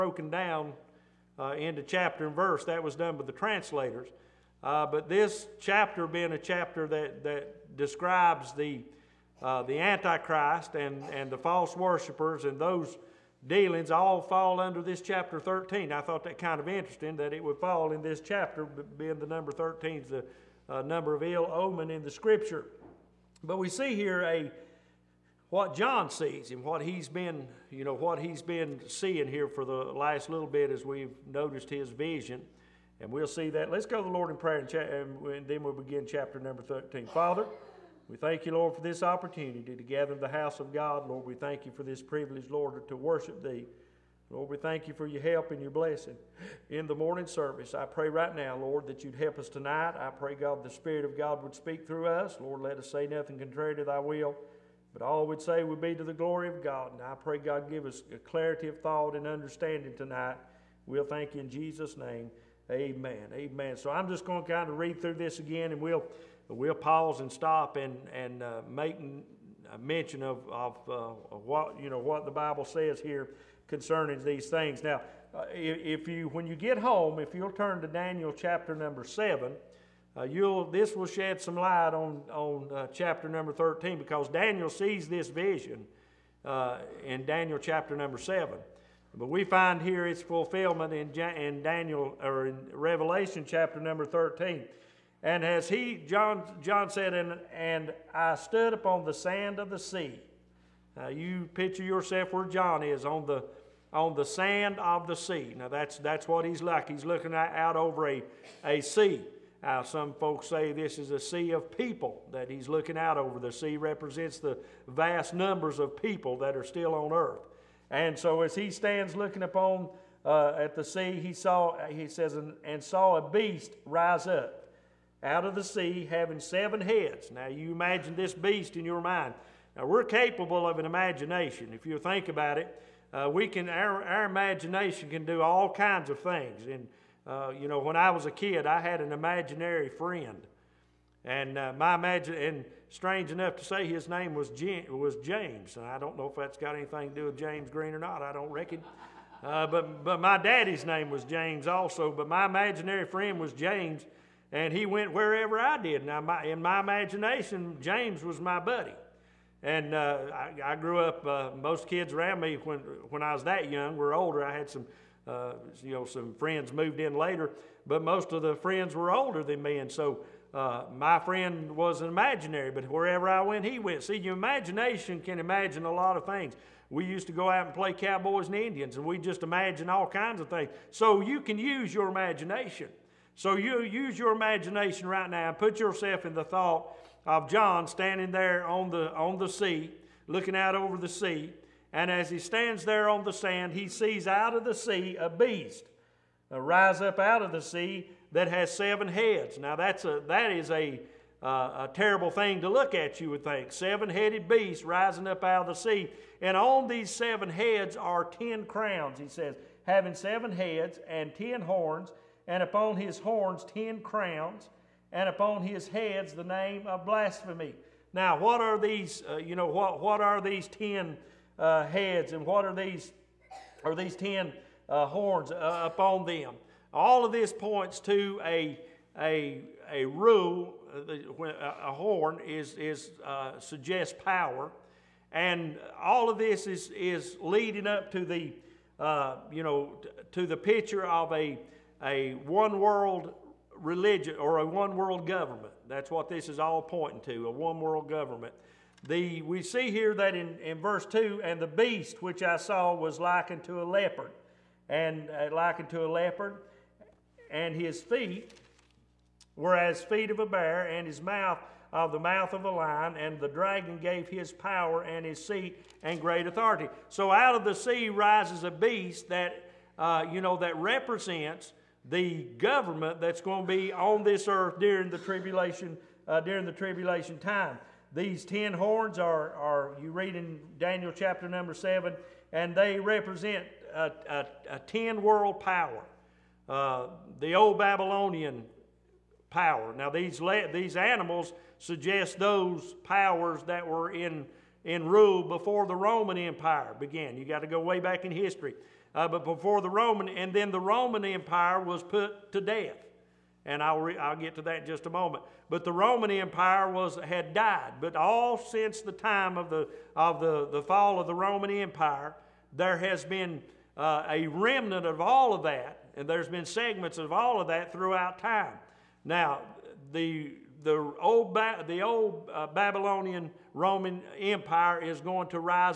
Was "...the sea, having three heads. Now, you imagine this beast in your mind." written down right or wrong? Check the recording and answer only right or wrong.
wrong.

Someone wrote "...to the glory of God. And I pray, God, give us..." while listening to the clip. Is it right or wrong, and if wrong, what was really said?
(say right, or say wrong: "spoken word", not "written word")
right.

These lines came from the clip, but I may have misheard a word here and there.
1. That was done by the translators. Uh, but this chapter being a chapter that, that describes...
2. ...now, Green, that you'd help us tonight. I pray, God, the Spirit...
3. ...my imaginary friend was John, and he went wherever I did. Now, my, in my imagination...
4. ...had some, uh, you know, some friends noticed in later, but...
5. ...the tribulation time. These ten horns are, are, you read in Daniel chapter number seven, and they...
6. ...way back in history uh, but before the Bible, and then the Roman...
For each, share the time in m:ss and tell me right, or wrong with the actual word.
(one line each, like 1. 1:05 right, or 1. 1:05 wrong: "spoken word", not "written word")
1. 0:02 right
2. 0:48 wrong: "Lord", not "Green"
3. 2:32 wrong: "James", not "John"
4. 2:44 wrong: "moved", not "noticed"
5. 4:36 right
6. 4:57 wrong: "Roman", not "Bible".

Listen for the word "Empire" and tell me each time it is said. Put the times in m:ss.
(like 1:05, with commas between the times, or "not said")
4:56, 5:01, 5:06, 5:11, 5:24.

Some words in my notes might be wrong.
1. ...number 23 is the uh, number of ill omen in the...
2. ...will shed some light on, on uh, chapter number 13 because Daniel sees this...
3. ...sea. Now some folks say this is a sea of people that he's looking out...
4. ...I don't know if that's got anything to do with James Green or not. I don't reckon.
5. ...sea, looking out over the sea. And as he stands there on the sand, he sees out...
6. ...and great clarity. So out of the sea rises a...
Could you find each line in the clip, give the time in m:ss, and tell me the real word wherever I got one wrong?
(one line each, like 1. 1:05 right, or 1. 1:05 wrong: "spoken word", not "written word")
1. 0:19 wrong: "13", not "23"
2. 1:20 right
3. 1:48 right
4. 2:25 right
5. 3:09 right
6. 4:26 wrong: "authority", not "clarity".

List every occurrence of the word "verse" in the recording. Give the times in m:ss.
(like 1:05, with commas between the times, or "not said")
0:02, 4:10.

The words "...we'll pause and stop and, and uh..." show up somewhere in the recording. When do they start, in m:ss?
1:06.